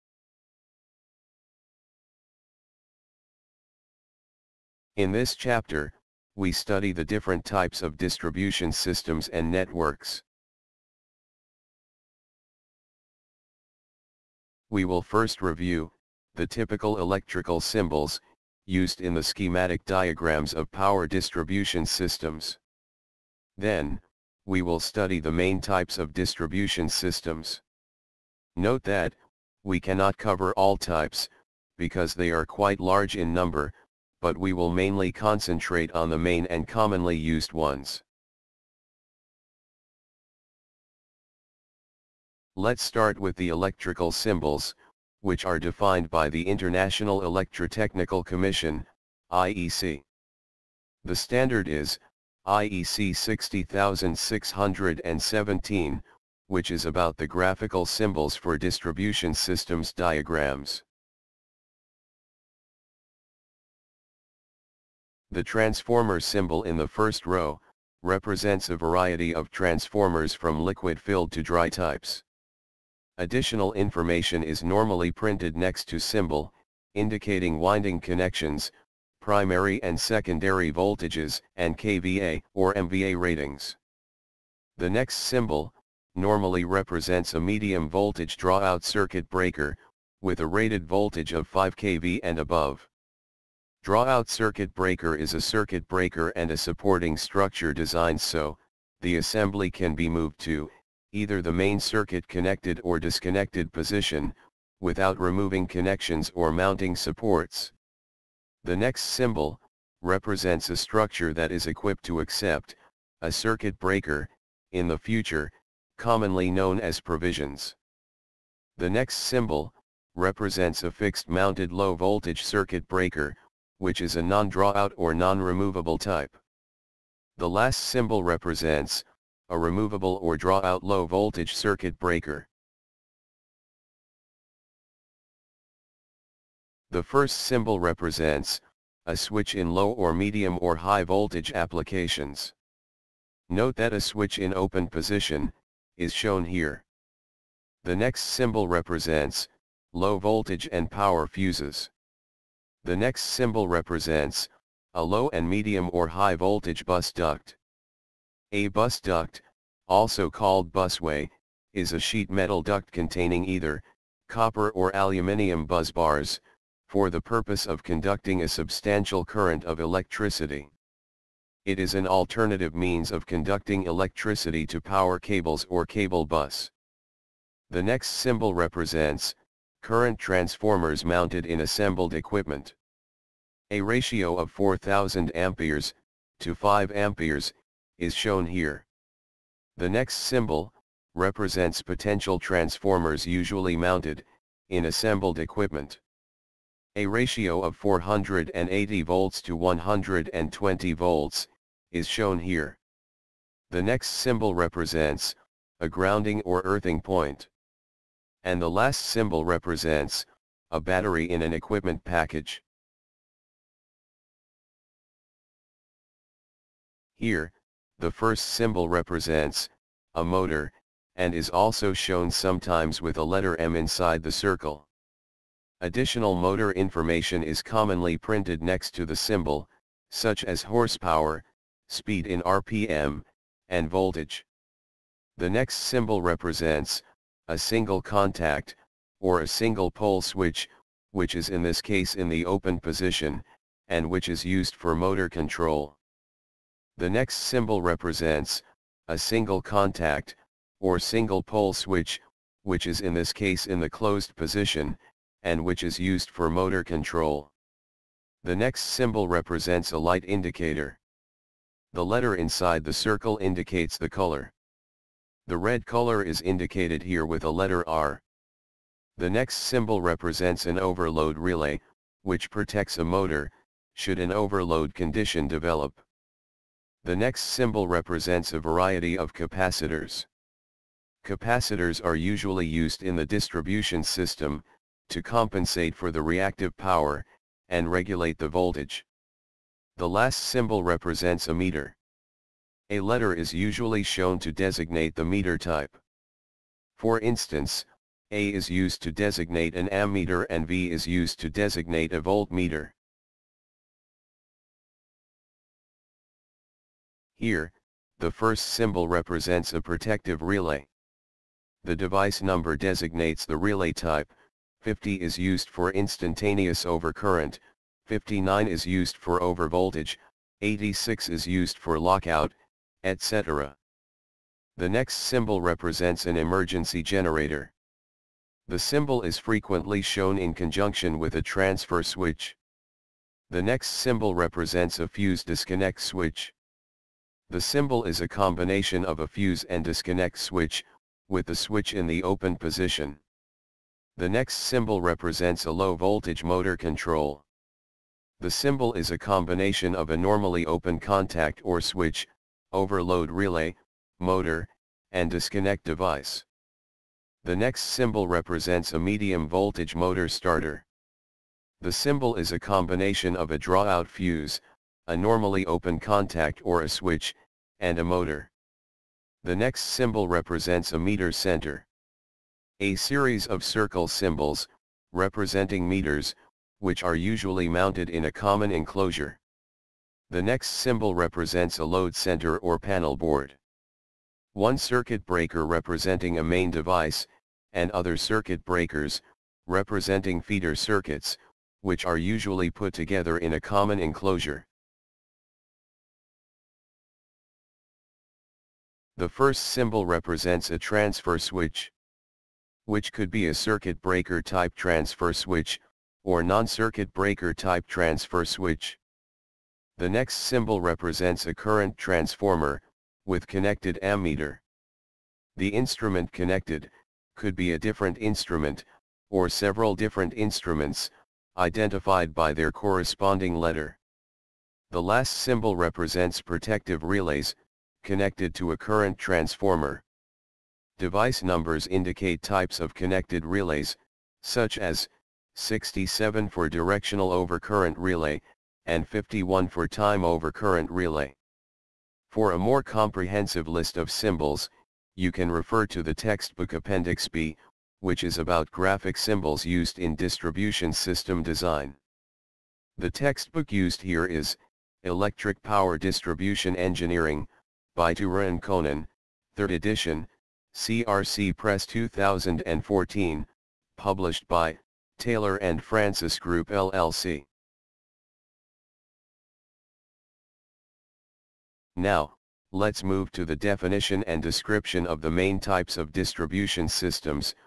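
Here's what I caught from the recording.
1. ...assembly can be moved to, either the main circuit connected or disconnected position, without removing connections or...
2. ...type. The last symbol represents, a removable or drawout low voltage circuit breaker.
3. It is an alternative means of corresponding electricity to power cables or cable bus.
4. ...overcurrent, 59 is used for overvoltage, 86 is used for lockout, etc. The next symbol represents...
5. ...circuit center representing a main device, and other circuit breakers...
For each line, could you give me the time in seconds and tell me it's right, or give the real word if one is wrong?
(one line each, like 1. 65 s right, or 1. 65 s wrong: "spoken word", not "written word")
1. 99 s right
2. 125 s right
3. 171 s wrong: "conducting", not "corresponding"
4. 316 s right
5. 384 s wrong: "breaker", not "center".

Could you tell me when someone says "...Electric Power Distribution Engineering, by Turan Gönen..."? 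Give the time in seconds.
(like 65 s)
455 s.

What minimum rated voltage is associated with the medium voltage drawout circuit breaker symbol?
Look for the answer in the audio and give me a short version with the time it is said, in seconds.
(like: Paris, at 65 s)
5 kV, at 91 s.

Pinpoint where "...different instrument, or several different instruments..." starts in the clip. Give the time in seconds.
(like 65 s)
417 s.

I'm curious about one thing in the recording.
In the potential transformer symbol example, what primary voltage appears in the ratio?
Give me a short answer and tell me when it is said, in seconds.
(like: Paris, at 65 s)
480 volts, at 197 s.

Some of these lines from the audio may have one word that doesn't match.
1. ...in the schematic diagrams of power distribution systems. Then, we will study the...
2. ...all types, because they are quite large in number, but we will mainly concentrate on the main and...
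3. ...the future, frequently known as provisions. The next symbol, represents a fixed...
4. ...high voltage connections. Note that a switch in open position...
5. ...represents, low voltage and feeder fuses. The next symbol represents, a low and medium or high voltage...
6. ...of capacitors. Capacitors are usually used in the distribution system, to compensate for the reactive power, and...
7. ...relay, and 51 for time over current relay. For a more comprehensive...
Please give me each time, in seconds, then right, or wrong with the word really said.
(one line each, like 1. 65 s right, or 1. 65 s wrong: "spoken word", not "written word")
1. 18 s right
2. 30 s right
3. 114 s wrong: "commonly", not "frequently"
4. 140 s wrong: "applications", not "connections"
5. 148 s wrong: "power", not "feeder"
6. 279 s right
7. 437 s right.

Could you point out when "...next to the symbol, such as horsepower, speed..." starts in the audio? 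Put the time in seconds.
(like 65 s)
228 s.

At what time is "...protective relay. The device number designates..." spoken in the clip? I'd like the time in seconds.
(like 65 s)
309 s.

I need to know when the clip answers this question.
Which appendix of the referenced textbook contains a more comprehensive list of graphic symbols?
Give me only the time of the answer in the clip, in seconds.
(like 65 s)
446 s.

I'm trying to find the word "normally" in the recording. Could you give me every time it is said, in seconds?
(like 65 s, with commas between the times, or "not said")
74 s, 86 s, 350 s, 365 s.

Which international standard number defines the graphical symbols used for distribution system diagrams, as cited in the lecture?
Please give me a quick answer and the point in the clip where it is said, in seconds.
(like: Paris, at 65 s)
IEC 60617, at 52 s.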